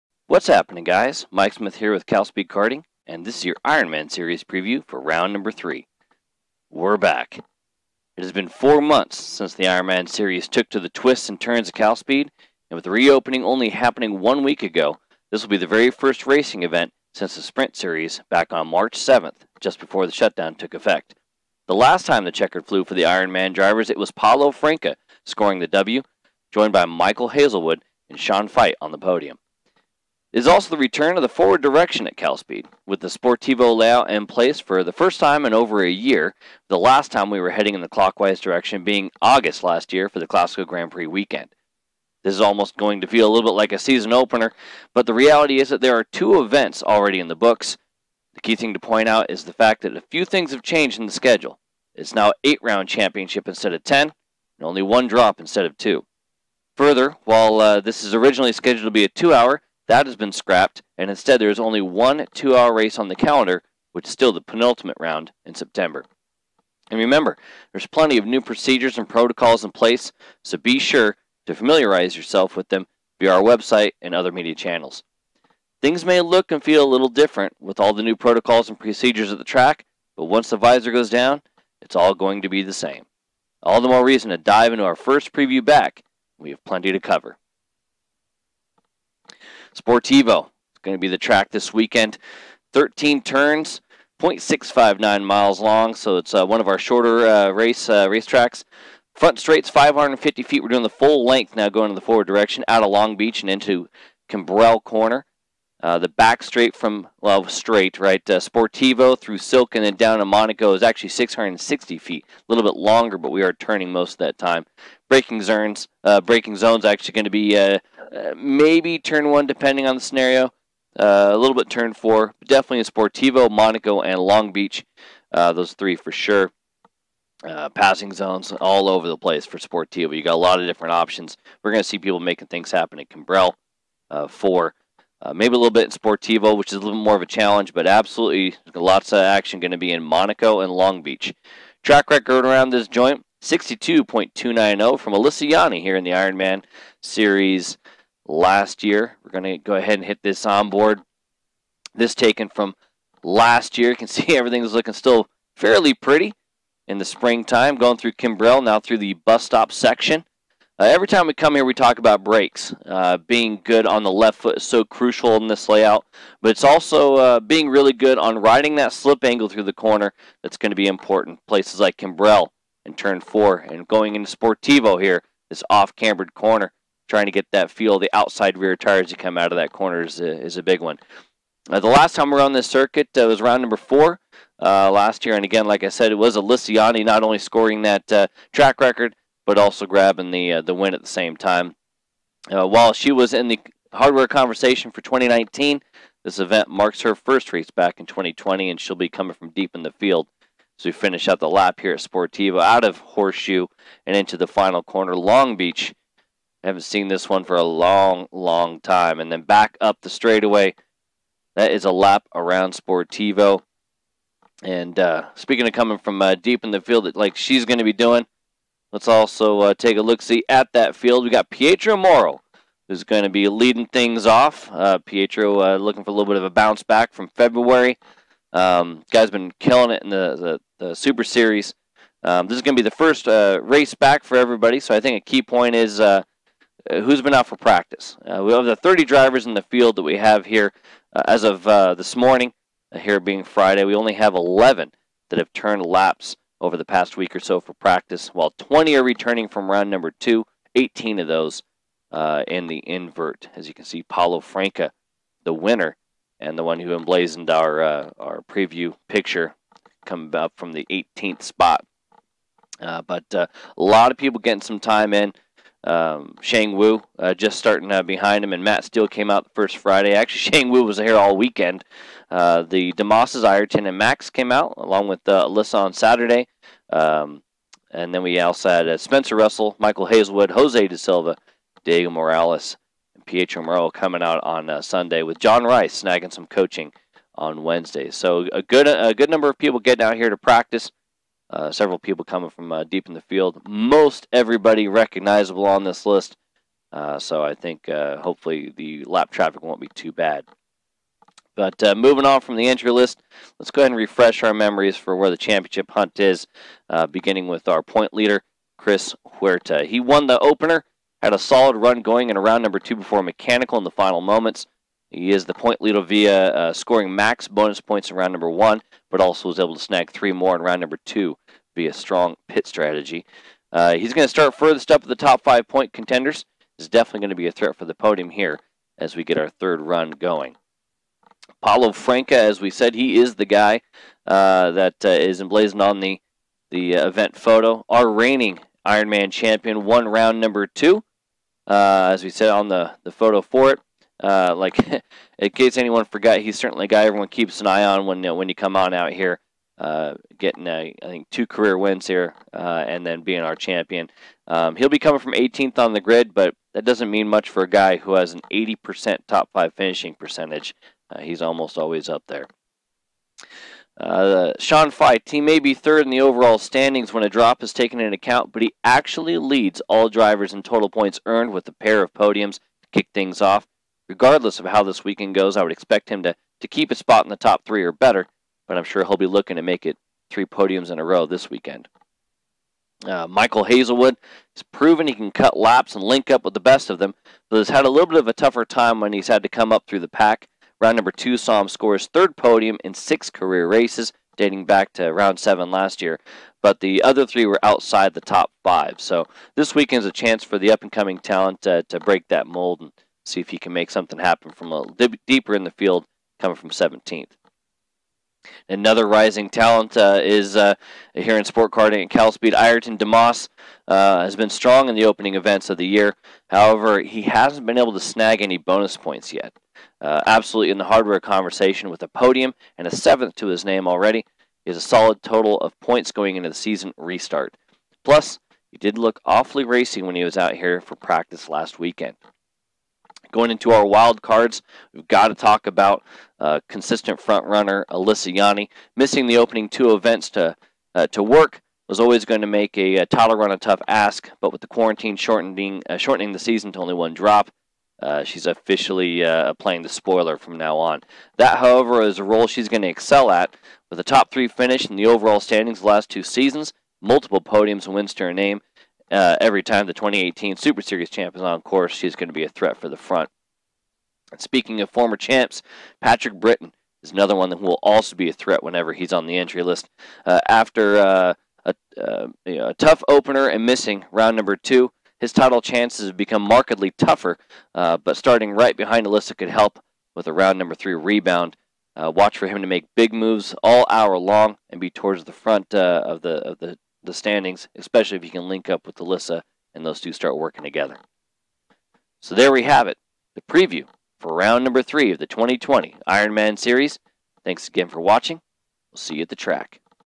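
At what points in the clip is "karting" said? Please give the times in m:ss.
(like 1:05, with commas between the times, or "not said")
0:02, 6:51.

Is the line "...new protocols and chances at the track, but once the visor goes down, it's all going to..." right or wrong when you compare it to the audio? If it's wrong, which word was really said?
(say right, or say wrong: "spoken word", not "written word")
wrong: "procedures", not "chances".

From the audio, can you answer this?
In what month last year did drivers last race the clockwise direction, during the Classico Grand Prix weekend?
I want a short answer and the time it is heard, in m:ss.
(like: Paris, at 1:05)
August, at 0:39.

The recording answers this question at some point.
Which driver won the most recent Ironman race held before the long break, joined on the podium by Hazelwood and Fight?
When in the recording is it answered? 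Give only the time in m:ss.
0:24.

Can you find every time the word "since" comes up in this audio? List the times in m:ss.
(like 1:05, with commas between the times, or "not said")
0:09, 0:17.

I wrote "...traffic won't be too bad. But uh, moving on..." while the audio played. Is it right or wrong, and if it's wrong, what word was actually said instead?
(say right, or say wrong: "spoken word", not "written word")
right.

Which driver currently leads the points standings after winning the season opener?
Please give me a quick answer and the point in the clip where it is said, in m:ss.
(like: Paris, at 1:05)
Chris Huerta, at 5:08.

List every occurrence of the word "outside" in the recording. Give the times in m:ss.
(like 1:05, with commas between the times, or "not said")
2:58, 6:37.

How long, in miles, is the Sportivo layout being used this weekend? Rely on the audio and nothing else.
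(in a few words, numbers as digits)
0.659 miles.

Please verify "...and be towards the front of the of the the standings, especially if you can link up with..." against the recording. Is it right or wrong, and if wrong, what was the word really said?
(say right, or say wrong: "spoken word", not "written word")
right.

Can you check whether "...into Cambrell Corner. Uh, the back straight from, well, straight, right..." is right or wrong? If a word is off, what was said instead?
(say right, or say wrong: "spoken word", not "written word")
right.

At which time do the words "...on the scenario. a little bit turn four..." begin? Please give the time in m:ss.
1:59.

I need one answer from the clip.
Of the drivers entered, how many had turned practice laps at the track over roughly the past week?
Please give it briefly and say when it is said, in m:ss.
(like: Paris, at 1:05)
11, at 4:04.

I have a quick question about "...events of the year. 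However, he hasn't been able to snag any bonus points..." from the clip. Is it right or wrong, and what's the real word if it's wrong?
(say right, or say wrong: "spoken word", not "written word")
right.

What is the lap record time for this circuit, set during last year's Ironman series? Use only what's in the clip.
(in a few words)
62.290.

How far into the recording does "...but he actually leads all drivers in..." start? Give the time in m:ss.
6:08.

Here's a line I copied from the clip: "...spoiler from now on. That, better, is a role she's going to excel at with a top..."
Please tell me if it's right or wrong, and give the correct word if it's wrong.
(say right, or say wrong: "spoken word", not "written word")
wrong: "however", not "better".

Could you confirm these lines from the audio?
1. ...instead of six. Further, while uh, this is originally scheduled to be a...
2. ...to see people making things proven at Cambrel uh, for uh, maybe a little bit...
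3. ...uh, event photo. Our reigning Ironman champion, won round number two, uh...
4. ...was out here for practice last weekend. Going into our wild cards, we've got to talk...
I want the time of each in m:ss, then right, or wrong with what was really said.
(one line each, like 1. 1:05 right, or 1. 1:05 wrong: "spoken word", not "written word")
1. 0:55 wrong: "two", not "six"
2. 2:11 wrong: "happen", not "proven"
3. 5:36 right
4. 7:10 right.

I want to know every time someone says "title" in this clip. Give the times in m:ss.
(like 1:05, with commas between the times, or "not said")
7:23, 7:55.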